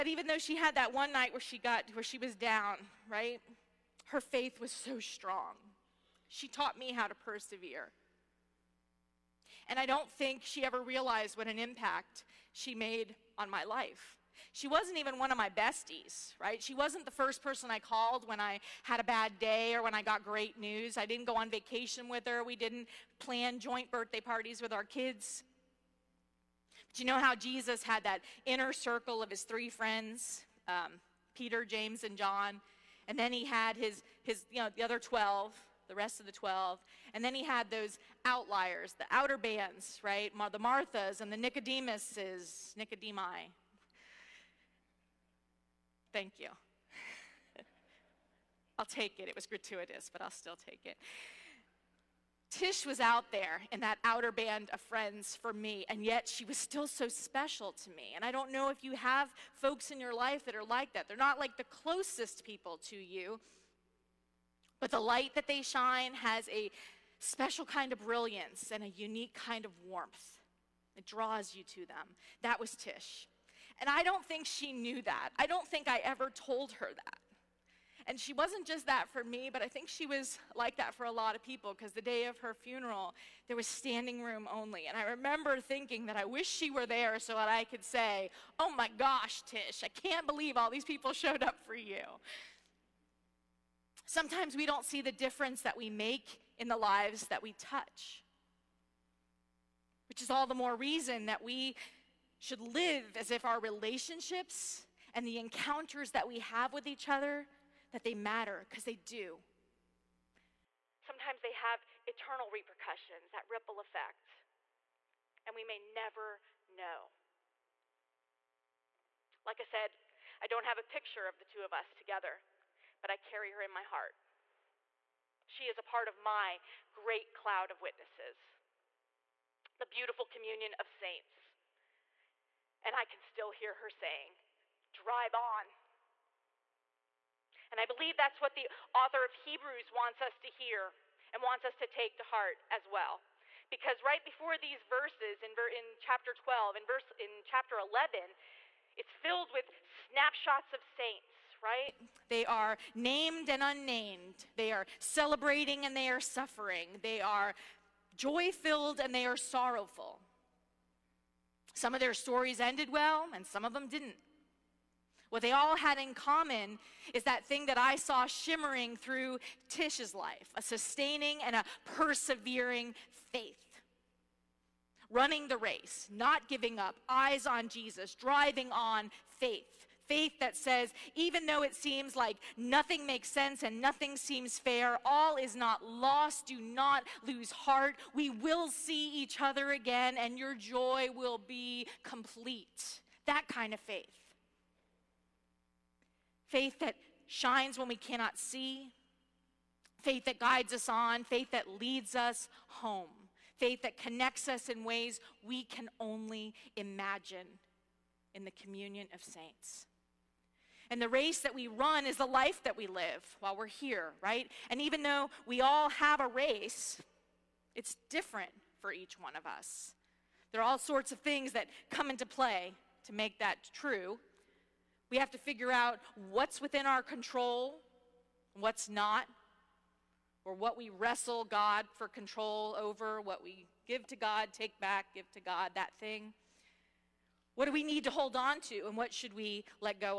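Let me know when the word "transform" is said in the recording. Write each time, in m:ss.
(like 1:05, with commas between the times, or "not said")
not said.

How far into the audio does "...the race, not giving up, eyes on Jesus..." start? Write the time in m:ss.
2:55.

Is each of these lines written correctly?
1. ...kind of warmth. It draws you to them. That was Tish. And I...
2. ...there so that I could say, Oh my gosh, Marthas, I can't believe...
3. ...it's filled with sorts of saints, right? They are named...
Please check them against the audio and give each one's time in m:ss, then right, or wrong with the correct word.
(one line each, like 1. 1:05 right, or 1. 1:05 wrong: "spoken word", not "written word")
1. 1:09 right
2. 1:26 wrong: "Tish", not "Marthas"
3. 2:28 wrong: "snapshots", not "sorts".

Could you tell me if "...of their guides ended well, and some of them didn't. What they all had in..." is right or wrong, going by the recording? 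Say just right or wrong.
wrong.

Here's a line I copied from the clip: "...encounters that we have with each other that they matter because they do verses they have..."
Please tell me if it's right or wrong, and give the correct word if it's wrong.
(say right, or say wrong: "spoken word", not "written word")
wrong: "sometimes", not "verses".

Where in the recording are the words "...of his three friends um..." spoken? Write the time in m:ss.
0:29.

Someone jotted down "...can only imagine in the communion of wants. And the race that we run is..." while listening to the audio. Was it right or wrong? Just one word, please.
wrong.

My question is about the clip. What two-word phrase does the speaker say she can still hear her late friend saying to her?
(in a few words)
Drive on.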